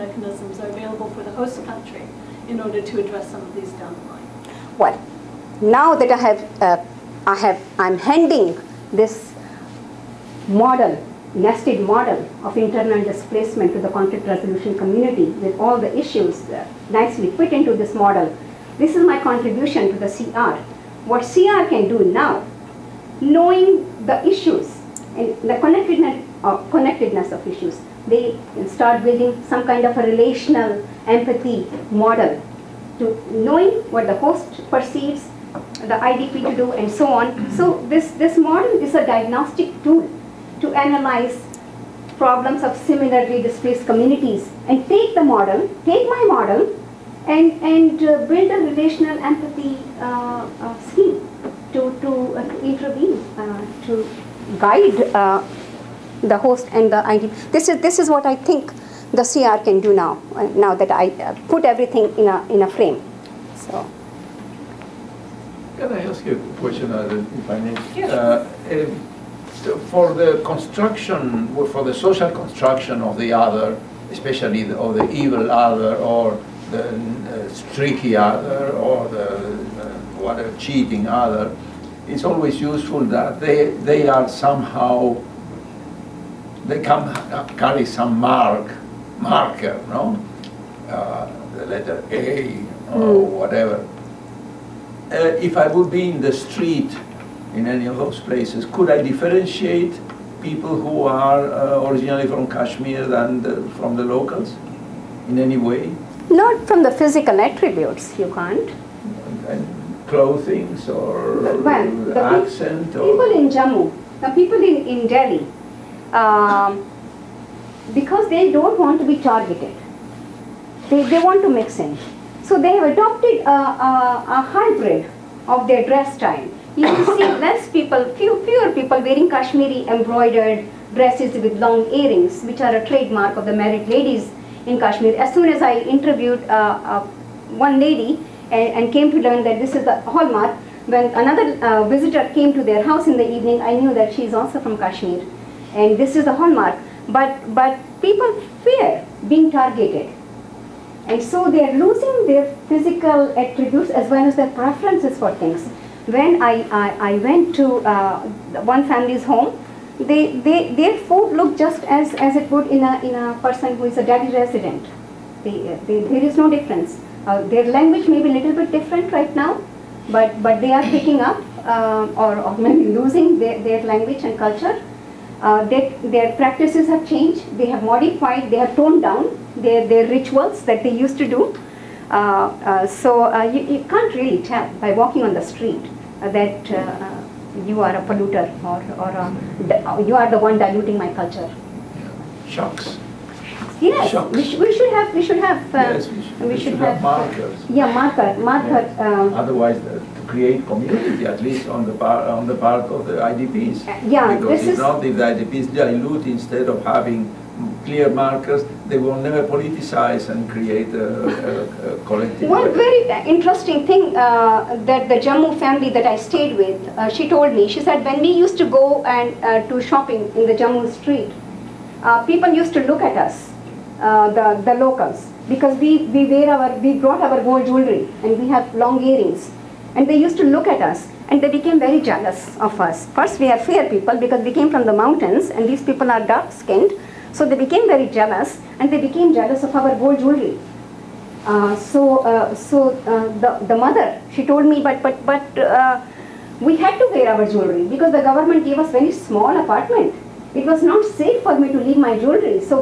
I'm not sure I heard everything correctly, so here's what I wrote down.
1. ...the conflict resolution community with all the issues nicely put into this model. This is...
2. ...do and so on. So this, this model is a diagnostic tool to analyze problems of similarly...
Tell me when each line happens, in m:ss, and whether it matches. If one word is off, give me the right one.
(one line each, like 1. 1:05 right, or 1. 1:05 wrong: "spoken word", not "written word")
1. 0:13 right
2. 0:36 right.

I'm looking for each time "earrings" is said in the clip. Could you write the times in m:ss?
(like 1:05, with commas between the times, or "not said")
2:11, 3:49.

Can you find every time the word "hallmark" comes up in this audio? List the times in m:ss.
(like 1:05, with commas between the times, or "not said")
2:20, 2:26.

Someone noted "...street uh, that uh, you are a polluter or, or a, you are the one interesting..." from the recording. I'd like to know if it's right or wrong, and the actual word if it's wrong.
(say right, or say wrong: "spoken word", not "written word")
wrong: "diluting", not "interesting".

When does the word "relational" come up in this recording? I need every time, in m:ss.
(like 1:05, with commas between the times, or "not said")
0:30, 0:48.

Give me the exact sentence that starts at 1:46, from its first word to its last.
Not from the physical attributes, you can't.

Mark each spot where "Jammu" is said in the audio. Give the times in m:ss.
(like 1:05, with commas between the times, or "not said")
1:53, 3:35, 3:40.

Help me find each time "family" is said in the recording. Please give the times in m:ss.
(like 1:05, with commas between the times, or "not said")
2:38, 3:35.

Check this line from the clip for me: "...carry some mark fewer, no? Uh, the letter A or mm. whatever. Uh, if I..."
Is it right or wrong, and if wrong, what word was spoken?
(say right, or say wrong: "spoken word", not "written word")
wrong: "marker", not "fewer".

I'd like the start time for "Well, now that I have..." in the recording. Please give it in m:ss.
0:04.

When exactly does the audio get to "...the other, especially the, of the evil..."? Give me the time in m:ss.
1:13.